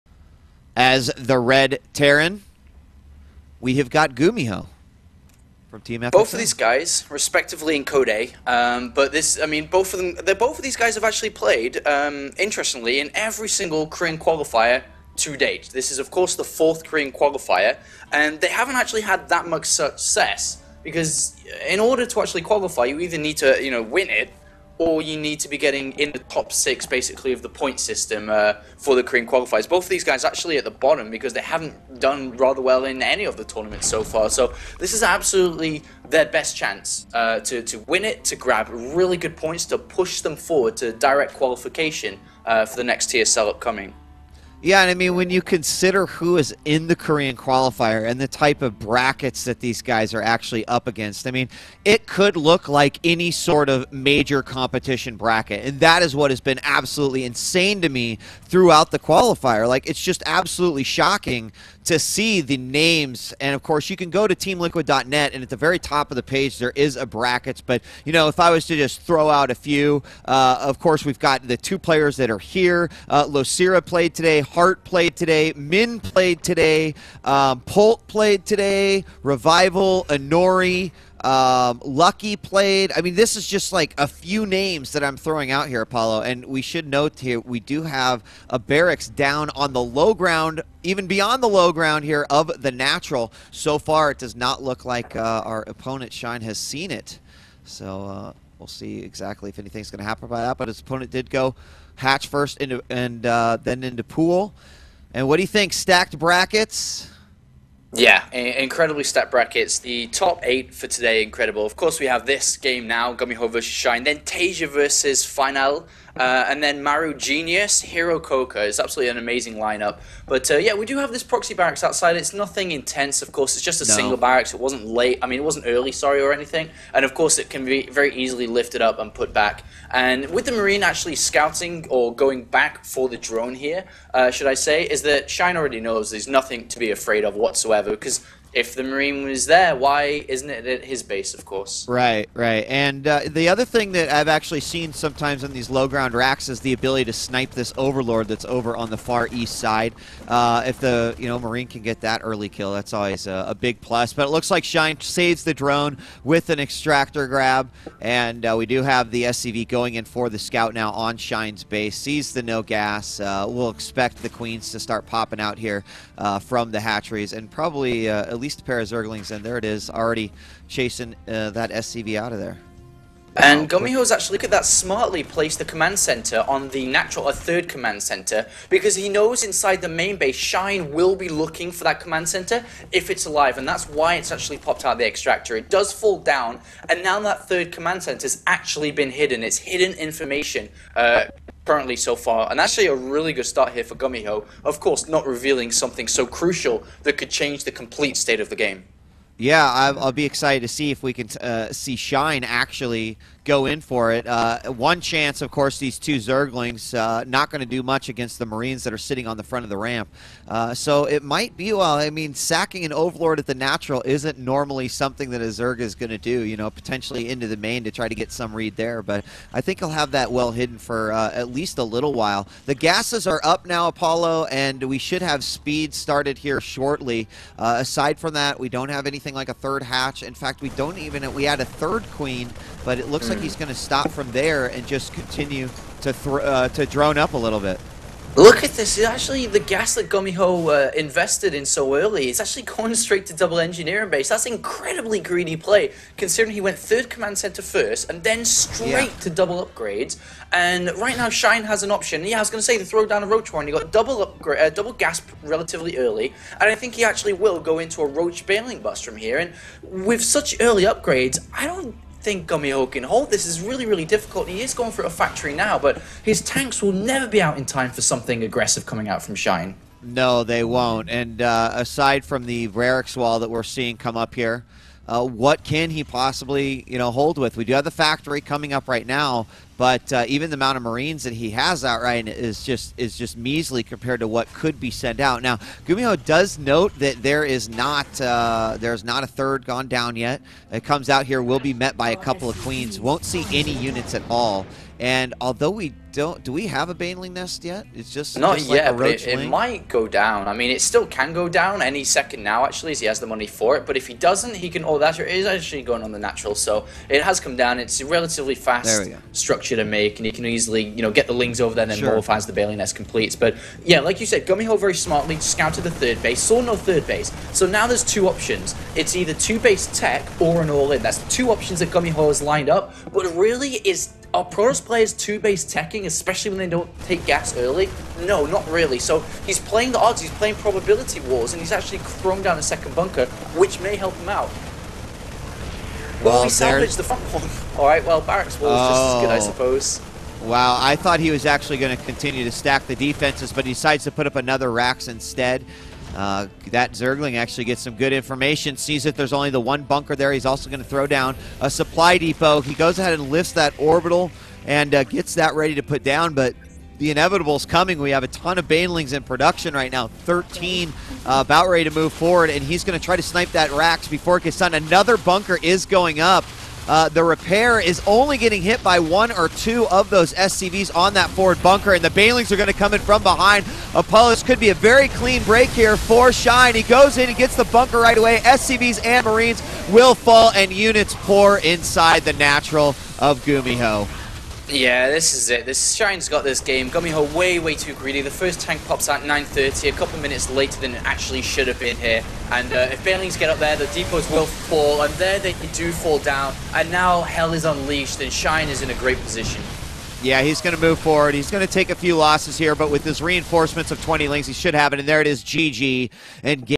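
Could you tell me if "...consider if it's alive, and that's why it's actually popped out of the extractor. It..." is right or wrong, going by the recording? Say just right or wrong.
wrong.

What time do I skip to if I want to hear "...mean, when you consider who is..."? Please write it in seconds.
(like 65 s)
44 s.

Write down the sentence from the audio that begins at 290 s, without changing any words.
It comes out here will be met by a couple of queens.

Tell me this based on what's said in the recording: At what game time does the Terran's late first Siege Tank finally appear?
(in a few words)
9:30.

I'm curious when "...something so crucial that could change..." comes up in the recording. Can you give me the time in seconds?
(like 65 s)
195 s.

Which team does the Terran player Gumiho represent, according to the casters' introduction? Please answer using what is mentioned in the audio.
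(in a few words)
FXO.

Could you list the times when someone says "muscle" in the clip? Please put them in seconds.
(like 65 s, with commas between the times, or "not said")
not said.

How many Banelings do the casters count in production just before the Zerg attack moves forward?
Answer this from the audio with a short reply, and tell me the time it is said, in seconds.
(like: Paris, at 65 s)
13, at 360 s.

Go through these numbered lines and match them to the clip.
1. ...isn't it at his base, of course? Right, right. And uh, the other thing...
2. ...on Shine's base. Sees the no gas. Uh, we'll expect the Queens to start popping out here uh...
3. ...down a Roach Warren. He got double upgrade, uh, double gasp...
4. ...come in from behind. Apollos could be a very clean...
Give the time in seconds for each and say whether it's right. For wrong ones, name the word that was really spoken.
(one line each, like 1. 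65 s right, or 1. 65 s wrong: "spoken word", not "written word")
1. 140 s right
2. 160 s right
3. 253 s right
4. 372 s right.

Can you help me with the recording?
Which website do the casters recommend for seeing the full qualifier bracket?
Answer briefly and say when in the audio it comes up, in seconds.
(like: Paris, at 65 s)
teamliquid.net, at 64 s.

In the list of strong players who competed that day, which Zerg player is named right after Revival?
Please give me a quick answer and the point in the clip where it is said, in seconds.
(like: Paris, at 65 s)
Honori, at 80 s.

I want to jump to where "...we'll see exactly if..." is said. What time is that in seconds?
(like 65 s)
98 s.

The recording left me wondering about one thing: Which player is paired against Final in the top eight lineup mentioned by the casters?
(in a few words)
Taeja.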